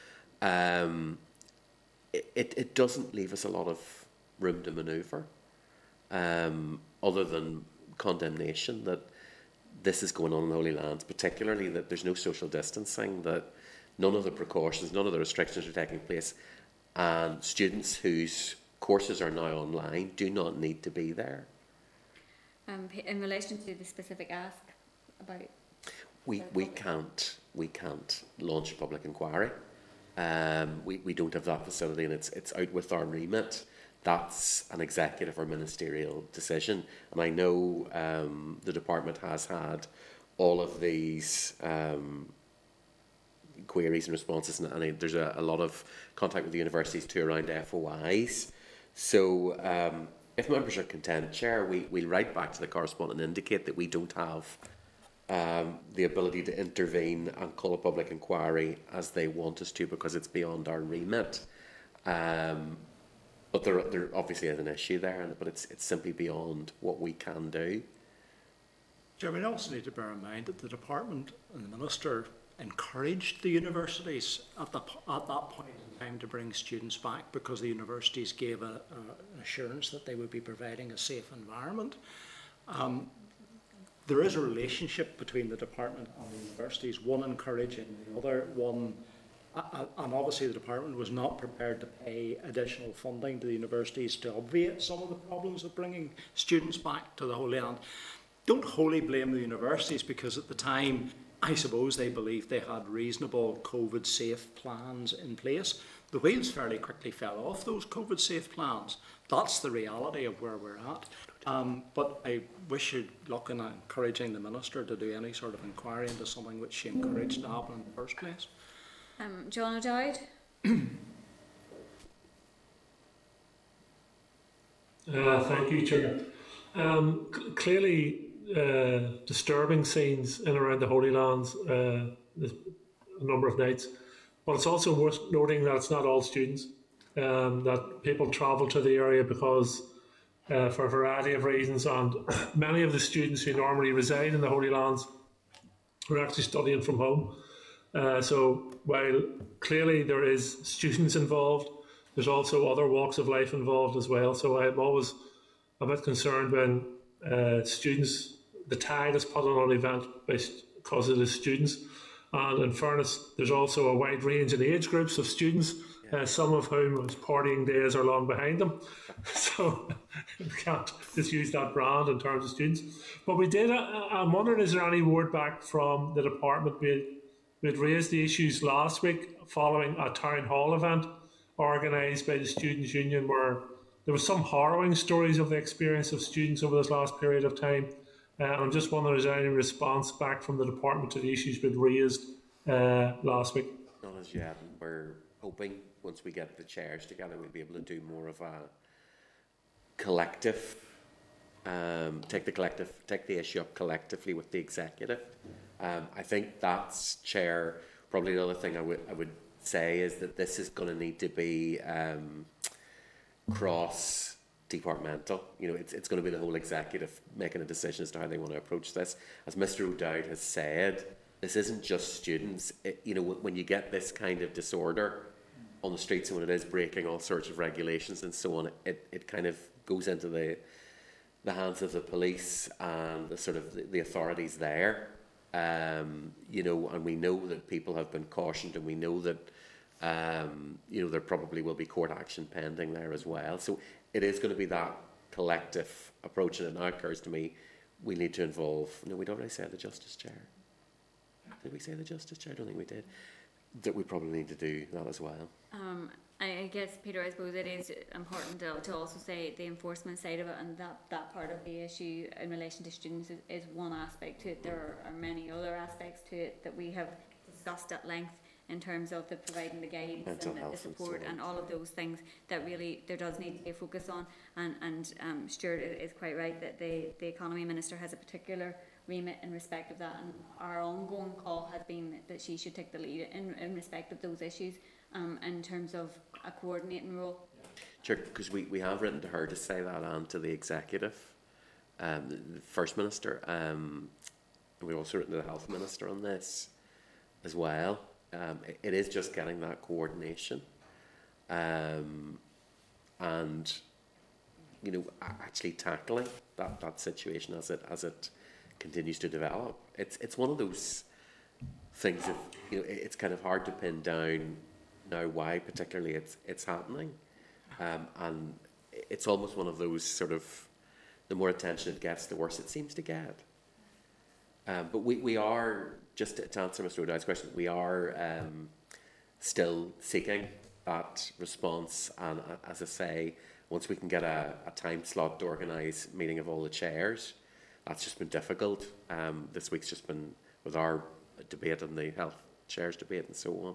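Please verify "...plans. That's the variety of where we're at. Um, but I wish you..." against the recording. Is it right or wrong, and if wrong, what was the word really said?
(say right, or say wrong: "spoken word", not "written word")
wrong: "reality", not "variety".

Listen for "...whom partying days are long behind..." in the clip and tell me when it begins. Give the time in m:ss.
2:46.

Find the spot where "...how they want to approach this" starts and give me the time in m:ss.
3:38.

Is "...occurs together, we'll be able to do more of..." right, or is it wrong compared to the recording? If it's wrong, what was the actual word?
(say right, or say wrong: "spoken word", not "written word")
wrong: "chairs", not "occurs".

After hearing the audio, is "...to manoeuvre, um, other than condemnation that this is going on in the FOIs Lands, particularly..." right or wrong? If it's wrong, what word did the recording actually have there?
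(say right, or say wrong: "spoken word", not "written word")
wrong: "Holy", not "FOIs".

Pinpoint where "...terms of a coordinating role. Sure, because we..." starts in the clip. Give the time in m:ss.
4:45.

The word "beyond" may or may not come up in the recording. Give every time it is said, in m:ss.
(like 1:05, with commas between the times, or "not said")
1:00, 1:06.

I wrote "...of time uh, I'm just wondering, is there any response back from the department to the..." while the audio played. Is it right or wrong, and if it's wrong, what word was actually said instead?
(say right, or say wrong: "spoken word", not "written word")
right.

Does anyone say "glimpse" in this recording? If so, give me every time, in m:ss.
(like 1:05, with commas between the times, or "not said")
not said.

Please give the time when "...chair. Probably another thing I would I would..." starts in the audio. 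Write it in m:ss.
3:27.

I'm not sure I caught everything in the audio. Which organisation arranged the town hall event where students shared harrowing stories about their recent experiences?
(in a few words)
Students' Union.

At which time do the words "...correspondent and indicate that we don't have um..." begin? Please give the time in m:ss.
0:52.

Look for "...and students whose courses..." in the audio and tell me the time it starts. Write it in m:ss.
0:16.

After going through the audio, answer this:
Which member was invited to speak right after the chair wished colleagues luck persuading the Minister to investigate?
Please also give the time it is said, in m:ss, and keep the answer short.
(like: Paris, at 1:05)
John O'Dowd, at 1:59.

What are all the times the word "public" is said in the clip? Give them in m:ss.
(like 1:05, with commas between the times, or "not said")
0:28, 0:57.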